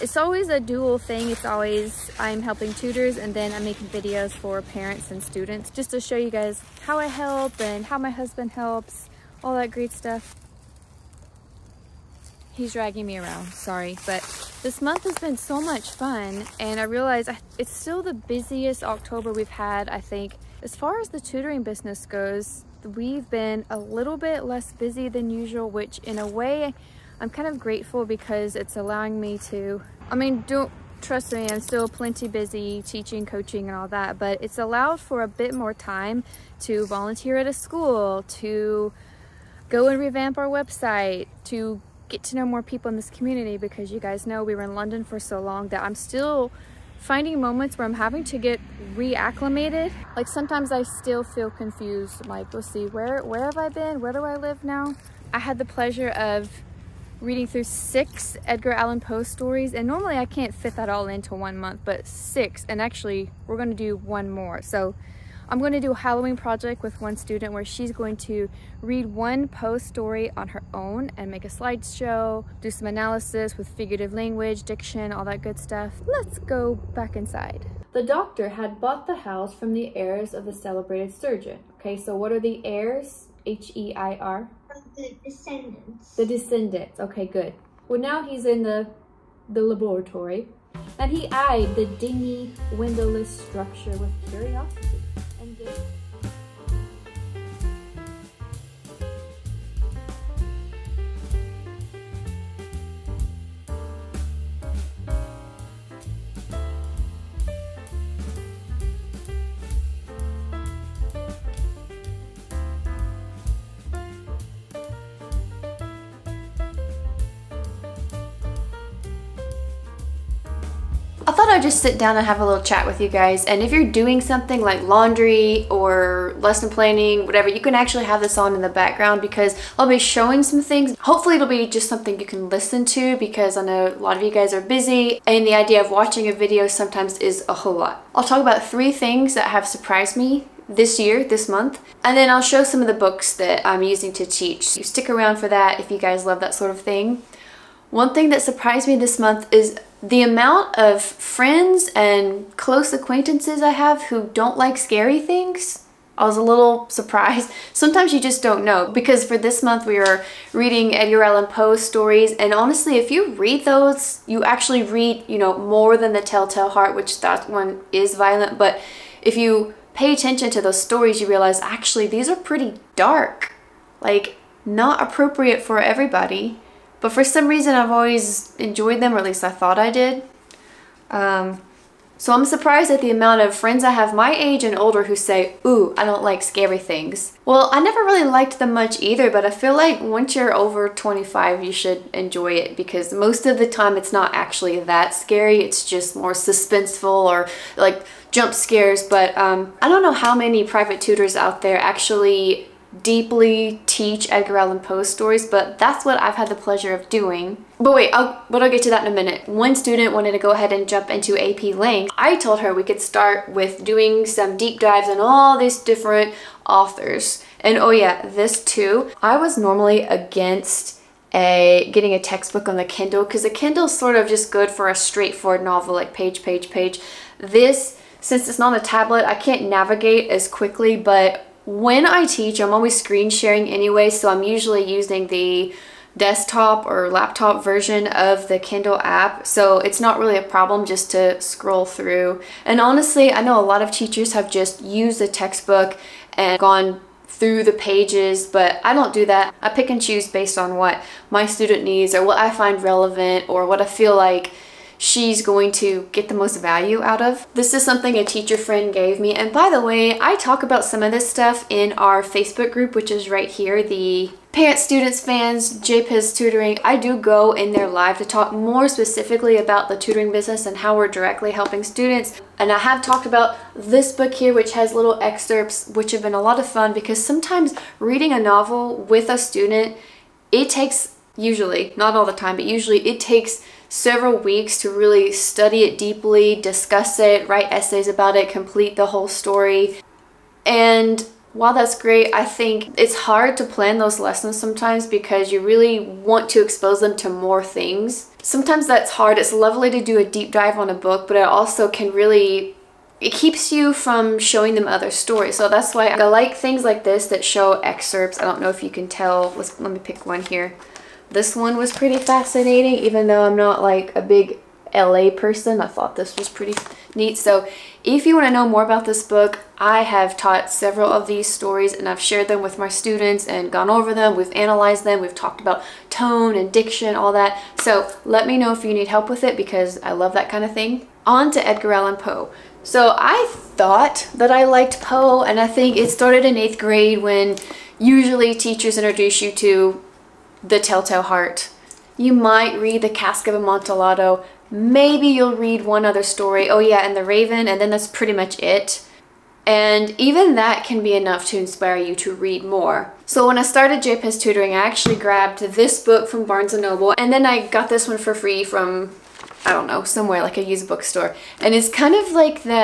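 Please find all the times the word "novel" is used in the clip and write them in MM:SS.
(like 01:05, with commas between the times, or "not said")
03:45, 04:38.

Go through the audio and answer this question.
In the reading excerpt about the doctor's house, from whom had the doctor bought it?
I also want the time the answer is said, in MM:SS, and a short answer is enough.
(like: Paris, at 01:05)
the heirs of the celebrated surgeon, at 01:19.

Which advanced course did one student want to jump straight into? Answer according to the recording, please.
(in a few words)
AP Lang.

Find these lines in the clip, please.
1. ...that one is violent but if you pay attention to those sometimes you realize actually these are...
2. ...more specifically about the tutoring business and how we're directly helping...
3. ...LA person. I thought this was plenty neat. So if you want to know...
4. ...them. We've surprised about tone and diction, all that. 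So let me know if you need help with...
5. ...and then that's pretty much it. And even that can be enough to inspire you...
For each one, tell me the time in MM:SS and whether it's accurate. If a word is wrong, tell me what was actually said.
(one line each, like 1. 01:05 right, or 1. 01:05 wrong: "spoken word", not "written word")
1. 02:47 wrong: "stories", not "sometimes"
2. 04:28 right
3. 05:14 wrong: "pretty", not "plenty"
4. 05:25 wrong: "talked", not "surprised"
5. 05:47 right.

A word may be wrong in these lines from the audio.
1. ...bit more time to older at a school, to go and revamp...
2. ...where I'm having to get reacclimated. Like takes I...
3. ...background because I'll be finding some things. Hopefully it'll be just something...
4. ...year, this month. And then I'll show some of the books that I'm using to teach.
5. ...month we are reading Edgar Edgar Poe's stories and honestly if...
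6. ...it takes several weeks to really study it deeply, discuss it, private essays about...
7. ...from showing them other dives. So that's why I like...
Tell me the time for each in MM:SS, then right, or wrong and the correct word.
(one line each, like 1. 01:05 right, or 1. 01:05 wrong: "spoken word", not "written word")
1. 00:35 wrong: "volunteer", not "older"
2. 00:47 wrong: "sometimes", not "takes"
3. 02:08 wrong: "showing", not "finding"
4. 02:20 right
5. 02:39 wrong: "Allan", not "Edgar"
6. 04:43 wrong: "write", not "private"
7. 05:03 wrong: "stories", not "dives".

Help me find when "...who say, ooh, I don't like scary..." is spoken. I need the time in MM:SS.
03:05.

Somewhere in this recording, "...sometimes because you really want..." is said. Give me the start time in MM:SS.
04:54.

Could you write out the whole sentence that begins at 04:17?
This is something a teacher friend gave me.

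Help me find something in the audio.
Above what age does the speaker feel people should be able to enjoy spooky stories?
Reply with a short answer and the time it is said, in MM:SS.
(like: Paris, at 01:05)
25, at 03:10.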